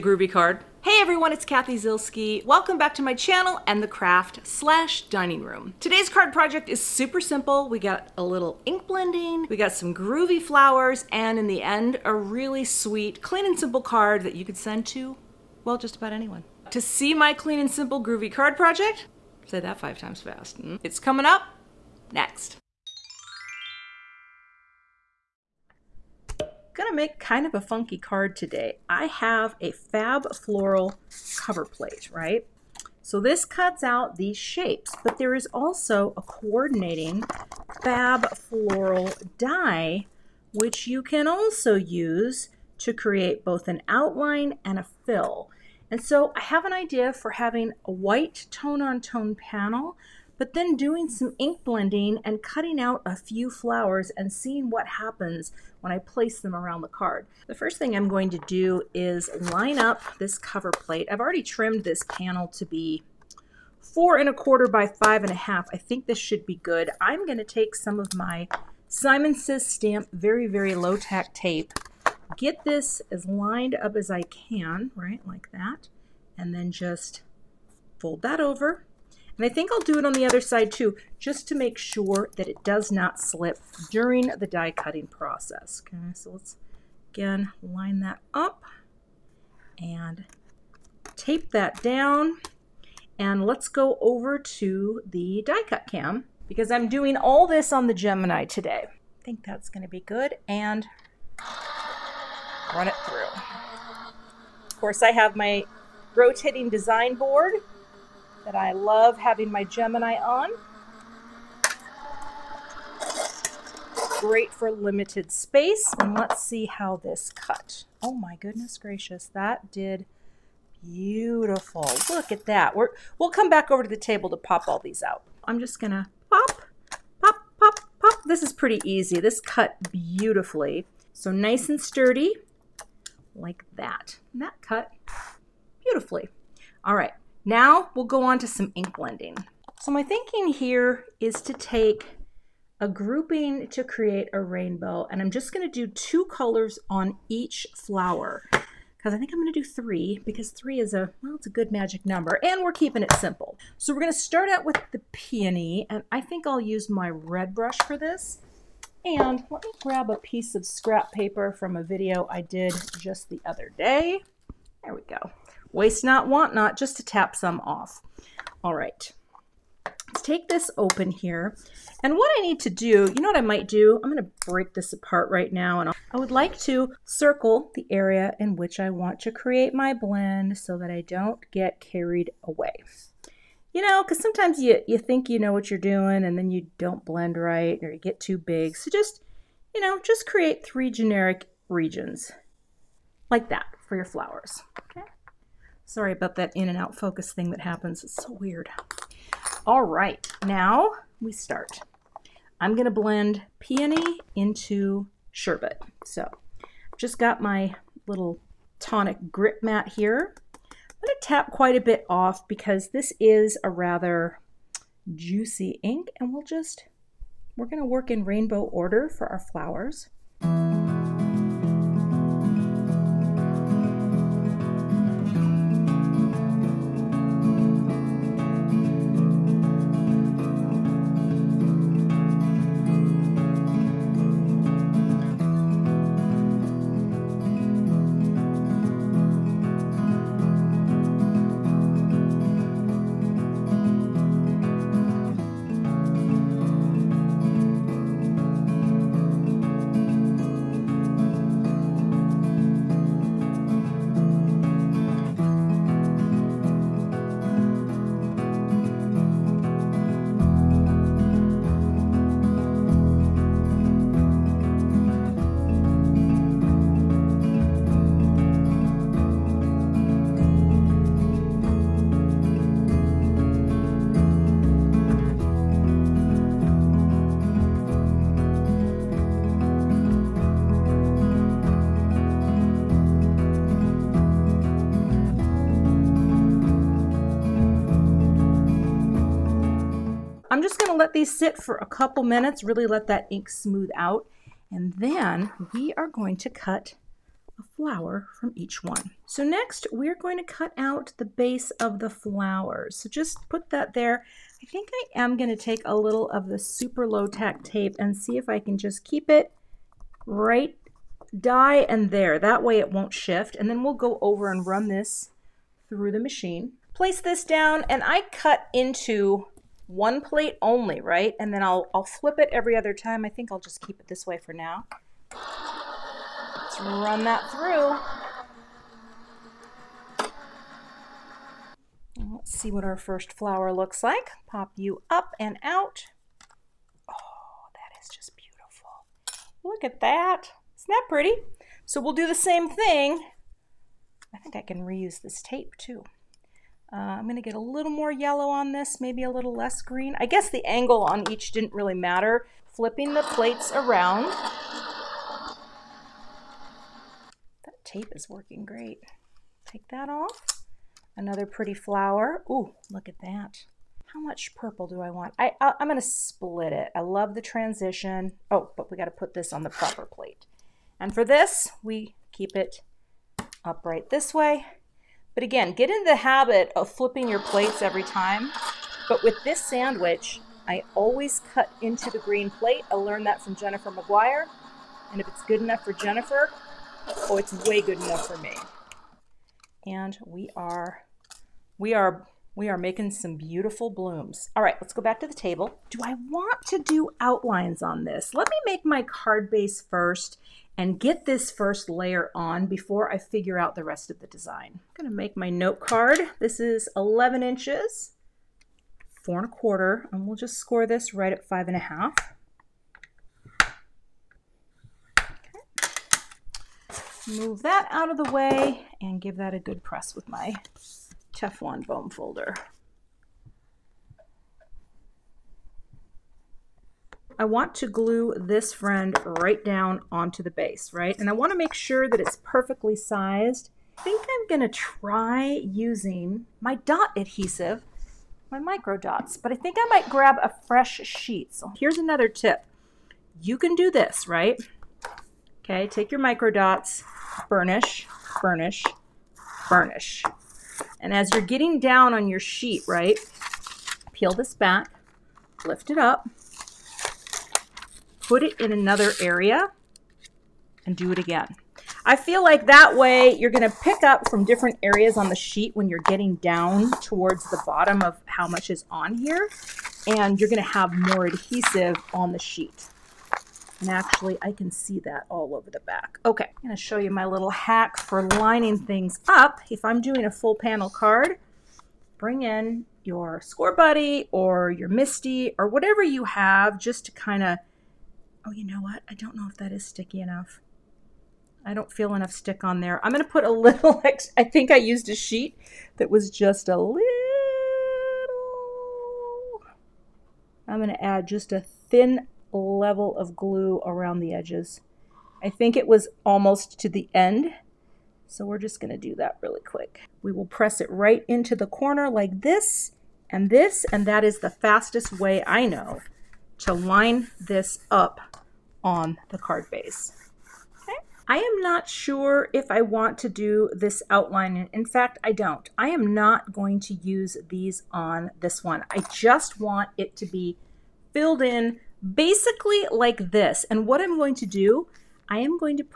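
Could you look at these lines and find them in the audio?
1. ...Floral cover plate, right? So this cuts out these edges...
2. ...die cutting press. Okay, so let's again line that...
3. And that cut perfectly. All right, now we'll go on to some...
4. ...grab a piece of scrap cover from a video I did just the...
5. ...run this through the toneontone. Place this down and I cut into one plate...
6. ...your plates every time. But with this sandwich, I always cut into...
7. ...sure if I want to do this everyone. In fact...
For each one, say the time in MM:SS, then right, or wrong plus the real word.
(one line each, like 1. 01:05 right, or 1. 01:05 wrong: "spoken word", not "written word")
1. 00:30 wrong: "shapes", not "edges"
2. 01:24 wrong: "process", not "press"
3. 02:14 wrong: "beautifully", not "perfectly"
4. 02:39 wrong: "paper", not "cover"
5. 05:14 wrong: "machine", not "toneontone"
6. 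06:17 right
7. 08:41 wrong: "outline", not "everyone".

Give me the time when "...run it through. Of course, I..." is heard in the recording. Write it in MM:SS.
01:42.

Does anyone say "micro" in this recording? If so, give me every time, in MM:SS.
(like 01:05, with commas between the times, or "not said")
07:18, 07:26.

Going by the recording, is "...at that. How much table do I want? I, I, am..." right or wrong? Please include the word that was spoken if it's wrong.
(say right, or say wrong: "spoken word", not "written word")
wrong: "purple", not "table".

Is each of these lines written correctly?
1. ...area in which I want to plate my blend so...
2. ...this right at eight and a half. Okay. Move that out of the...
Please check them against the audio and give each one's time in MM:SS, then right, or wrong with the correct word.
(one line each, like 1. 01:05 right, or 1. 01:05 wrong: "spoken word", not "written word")
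1. 02:57 wrong: "create", not "plate"
2. 06:50 wrong: "five", not "eight".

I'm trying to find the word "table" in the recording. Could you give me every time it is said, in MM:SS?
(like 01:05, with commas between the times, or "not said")
02:03, 06:35.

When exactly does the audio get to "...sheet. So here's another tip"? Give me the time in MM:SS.
07:21.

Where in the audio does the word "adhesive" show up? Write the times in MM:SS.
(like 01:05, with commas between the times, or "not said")
07:17, 07:51.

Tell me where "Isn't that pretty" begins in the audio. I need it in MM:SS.
05:40.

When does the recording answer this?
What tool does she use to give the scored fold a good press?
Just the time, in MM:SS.
07:01.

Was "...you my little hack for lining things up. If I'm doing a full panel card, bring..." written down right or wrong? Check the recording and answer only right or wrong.
right.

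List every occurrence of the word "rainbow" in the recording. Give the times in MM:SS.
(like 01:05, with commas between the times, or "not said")
02:24, 03:38.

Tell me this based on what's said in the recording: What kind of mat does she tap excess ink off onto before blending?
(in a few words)
Tonic grit mat.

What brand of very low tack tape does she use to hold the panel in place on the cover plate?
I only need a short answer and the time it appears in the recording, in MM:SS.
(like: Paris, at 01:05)
Simon Says Stamp, at 01:08.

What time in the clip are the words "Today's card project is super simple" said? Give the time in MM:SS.
00:05.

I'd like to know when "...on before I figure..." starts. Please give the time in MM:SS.
06:42.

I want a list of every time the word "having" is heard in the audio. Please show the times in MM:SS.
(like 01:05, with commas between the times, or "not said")
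00:47, 01:49.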